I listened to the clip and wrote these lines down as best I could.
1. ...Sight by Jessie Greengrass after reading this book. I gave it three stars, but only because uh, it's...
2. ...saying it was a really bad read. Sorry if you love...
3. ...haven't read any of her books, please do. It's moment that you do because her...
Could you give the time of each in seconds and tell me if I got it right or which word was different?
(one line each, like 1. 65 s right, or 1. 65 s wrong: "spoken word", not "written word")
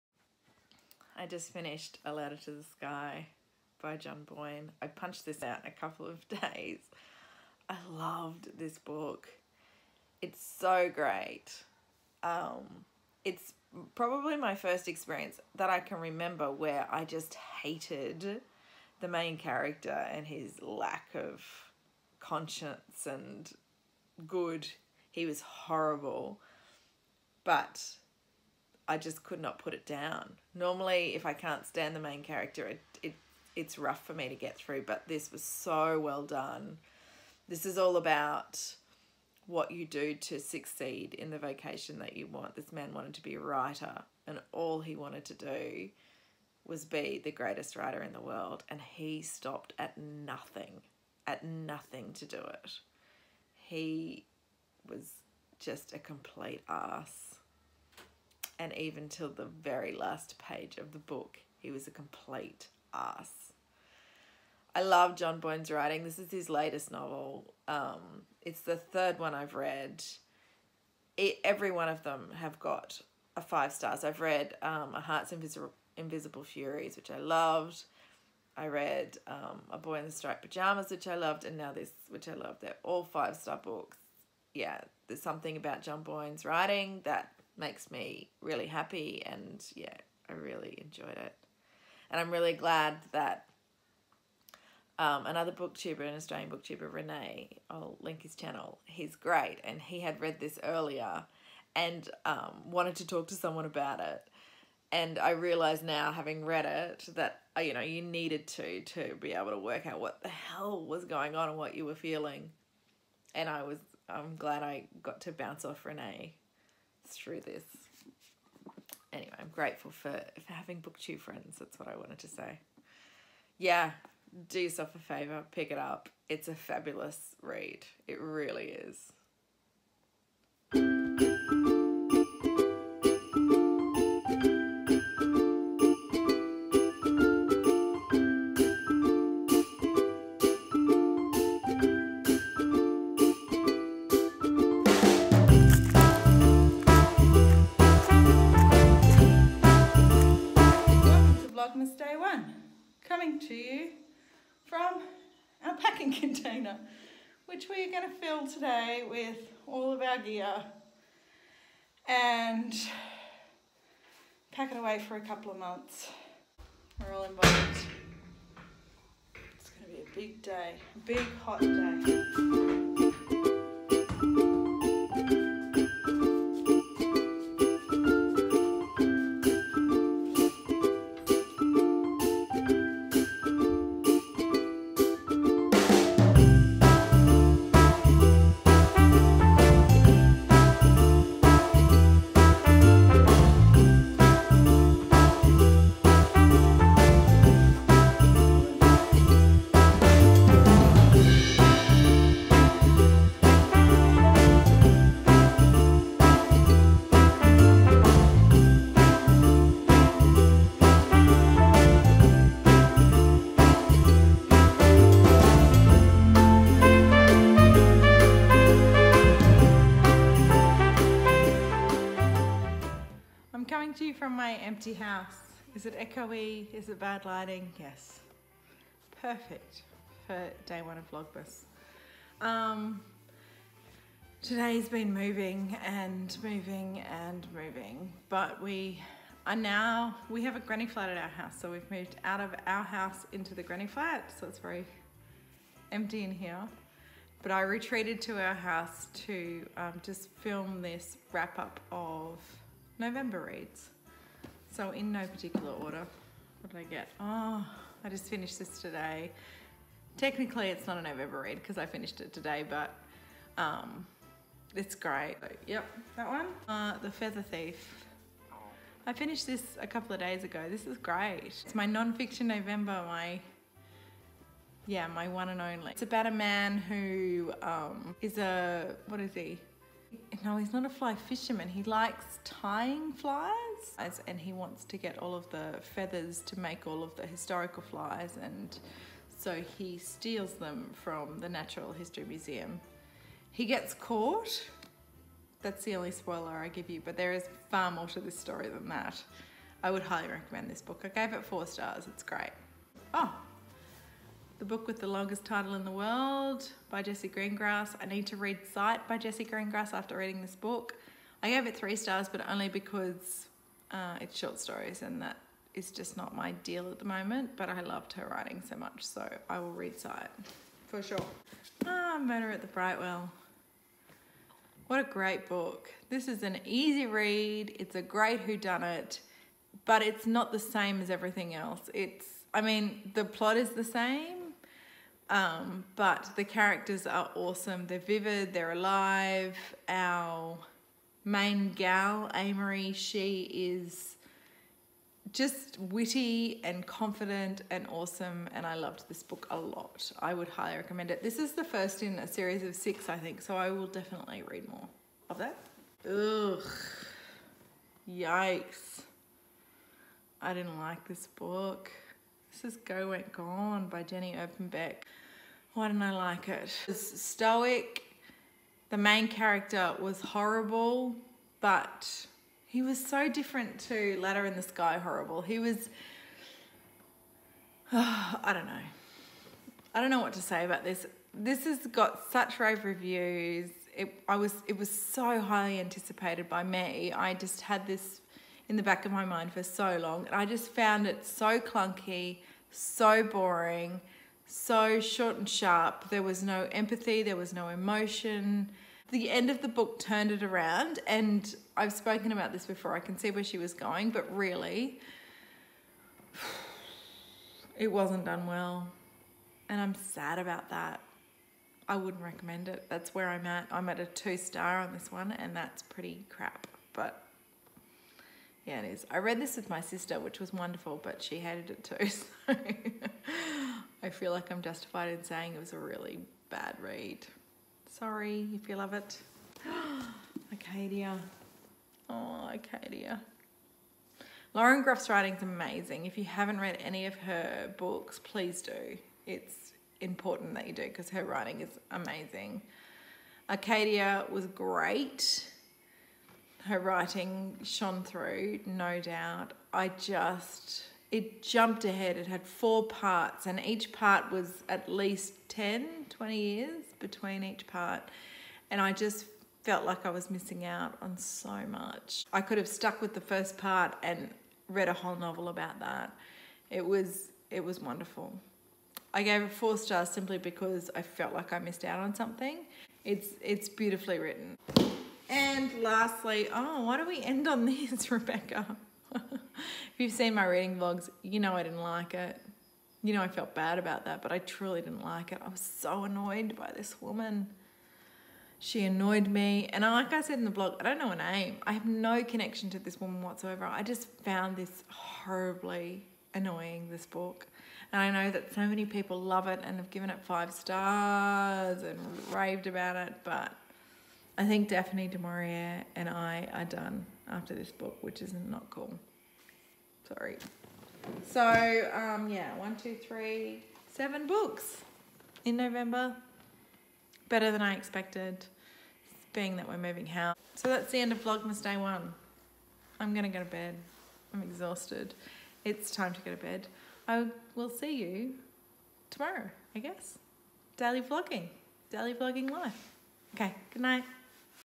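1. 308 s right
2. 425 s right
3. 436 s wrong: "important", not "moment".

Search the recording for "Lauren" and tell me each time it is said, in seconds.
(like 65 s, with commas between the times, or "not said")
434 s.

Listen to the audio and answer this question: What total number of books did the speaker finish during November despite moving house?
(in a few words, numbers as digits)
7.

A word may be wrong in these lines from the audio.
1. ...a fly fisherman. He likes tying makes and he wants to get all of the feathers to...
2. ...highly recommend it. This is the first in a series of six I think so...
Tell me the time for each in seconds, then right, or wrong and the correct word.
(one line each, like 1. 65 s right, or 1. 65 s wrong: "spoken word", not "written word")
1. 280 s wrong: "flies", not "makes"
2. 350 s right.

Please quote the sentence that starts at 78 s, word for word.
I read um, A Boy in the Striped Pajamas, which I loved, and now this, which I love.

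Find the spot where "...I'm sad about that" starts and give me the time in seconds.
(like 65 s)
409 s.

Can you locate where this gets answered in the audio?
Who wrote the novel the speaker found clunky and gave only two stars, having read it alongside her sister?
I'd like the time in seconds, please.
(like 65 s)
364 s.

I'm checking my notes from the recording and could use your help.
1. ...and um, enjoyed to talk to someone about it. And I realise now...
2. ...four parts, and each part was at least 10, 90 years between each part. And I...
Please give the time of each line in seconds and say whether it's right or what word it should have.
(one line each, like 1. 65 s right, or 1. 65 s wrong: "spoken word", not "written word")
1. 101 s wrong: "wanted", not "enjoyed"
2. 452 s wrong: "20", not "90".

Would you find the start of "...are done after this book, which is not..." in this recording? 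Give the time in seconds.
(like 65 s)
506 s.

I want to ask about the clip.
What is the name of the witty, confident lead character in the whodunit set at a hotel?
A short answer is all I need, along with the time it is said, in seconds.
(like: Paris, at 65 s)
Amory, at 342 s.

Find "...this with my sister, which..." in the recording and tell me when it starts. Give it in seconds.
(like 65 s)
419 s.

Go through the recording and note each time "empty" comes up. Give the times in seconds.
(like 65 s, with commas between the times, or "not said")
224 s, 245 s.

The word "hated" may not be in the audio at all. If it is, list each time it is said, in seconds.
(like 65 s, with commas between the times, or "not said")
17 s, 421 s.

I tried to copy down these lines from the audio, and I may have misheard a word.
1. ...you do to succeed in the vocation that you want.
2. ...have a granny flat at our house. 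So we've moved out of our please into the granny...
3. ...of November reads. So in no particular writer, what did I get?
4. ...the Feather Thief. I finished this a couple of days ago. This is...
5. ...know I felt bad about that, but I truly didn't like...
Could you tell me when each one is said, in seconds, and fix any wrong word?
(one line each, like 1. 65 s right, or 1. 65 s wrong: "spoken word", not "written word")
1. 39 s right
2. 240 s wrong: "house", not "please"
3. 251 s wrong: "order", not "writer"
4. 267 s right
5. 483 s right.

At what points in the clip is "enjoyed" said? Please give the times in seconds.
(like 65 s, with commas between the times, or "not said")
90 s.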